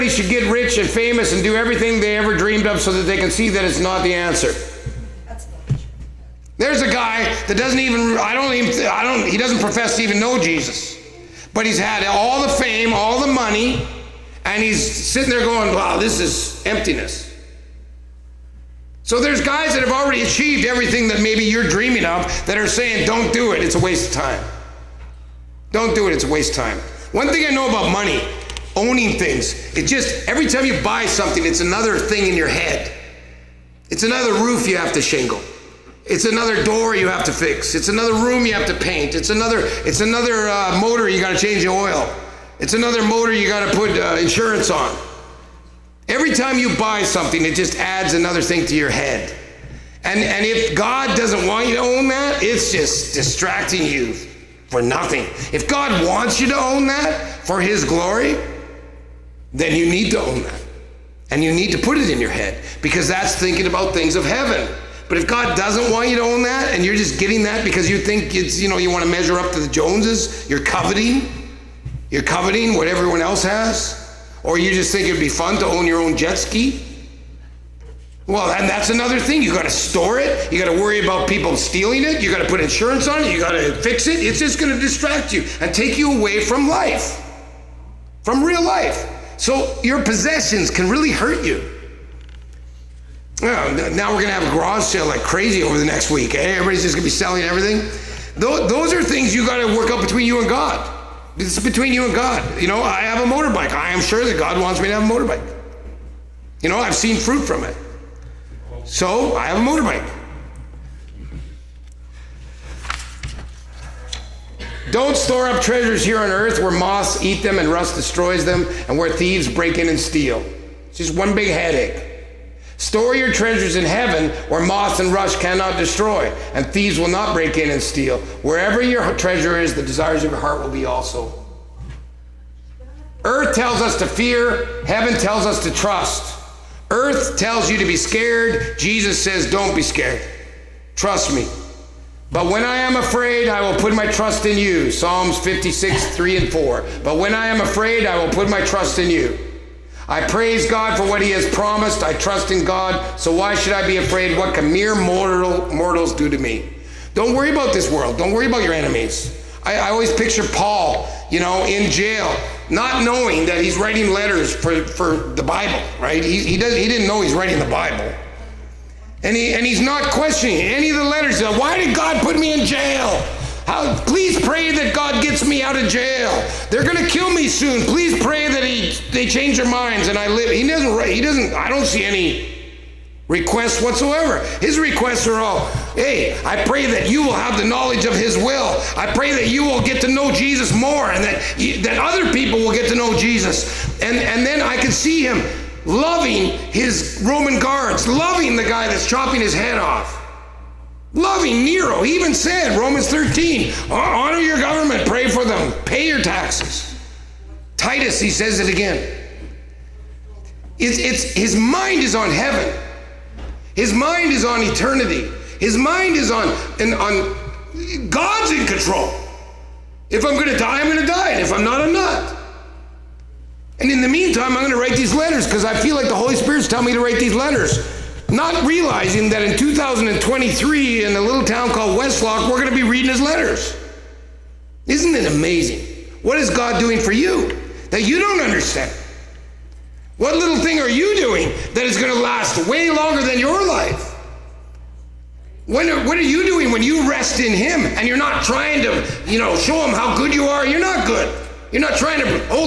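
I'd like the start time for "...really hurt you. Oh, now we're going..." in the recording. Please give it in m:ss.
1:30.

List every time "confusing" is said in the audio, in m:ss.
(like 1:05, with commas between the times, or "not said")
not said.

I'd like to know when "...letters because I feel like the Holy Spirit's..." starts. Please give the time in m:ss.
3:45.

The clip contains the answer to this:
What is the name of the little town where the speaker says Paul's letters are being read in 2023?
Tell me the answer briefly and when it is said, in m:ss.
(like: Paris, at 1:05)
Westlock, at 3:51.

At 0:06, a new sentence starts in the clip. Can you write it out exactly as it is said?
There's a guy that doesn't even, I don't even, I don't, he doesn't profess to even know Jesus.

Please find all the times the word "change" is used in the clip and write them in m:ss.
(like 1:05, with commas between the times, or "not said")
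0:41, 2:59.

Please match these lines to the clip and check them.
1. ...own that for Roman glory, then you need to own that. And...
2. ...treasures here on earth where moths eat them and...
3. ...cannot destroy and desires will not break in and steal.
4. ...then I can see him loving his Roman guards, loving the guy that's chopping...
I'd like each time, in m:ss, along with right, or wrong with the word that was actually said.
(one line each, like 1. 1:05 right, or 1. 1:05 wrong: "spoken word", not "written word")
1. 0:56 wrong: "His", not "Roman"
2. 1:55 right
3. 2:05 wrong: "thieves", not "desires"
4. 3:14 right.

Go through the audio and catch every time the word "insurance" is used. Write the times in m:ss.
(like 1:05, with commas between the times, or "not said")
0:44, 1:22.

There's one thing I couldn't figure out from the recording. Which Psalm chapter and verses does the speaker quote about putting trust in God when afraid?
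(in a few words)
Psalms 56:3-4.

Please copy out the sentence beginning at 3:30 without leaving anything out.
It's, it's, his mind is on heaven, his mind is on eternity, his mind is on, and on God's in control.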